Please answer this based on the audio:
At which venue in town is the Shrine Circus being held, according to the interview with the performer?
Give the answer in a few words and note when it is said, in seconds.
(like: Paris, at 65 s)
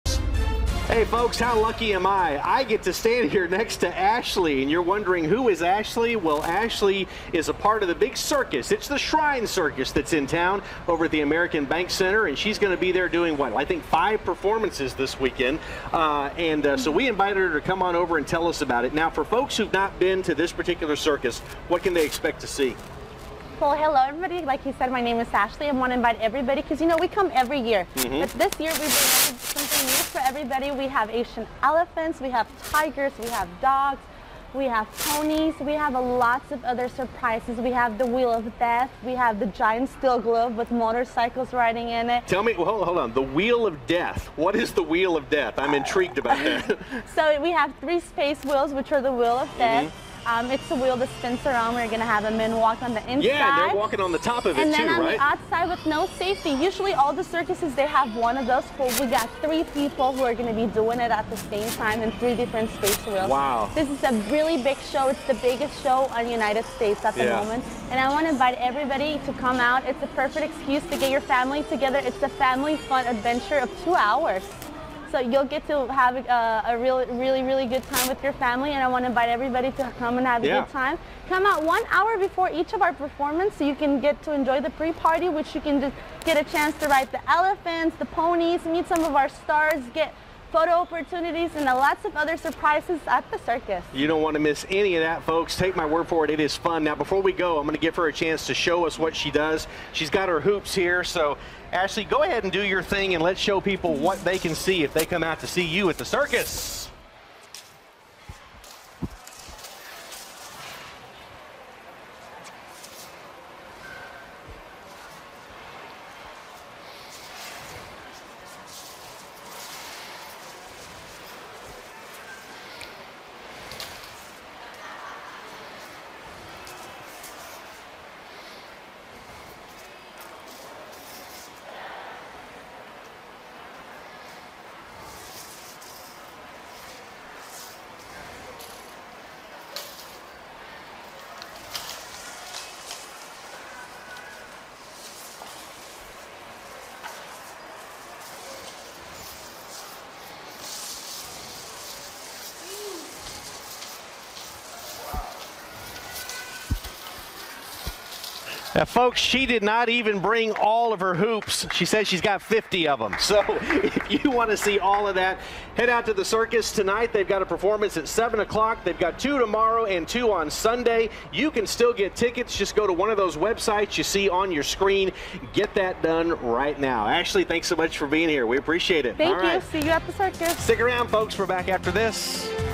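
American Bank Center, at 11 s.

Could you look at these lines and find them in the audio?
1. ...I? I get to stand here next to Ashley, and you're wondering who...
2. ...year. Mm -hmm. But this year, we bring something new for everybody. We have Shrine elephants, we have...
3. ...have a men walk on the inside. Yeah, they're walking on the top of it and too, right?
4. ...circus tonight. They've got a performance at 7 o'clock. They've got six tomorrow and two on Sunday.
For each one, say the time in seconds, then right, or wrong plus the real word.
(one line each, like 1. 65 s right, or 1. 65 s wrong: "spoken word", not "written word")
1. 2 s right
2. 27 s wrong: "Asian", not "Shrine"
3. 52 s right
4. 166 s wrong: "two", not "six".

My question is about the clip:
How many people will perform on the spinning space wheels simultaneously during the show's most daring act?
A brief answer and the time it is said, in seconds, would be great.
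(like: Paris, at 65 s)
3, at 59 s.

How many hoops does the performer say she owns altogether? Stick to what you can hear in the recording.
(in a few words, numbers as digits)
50.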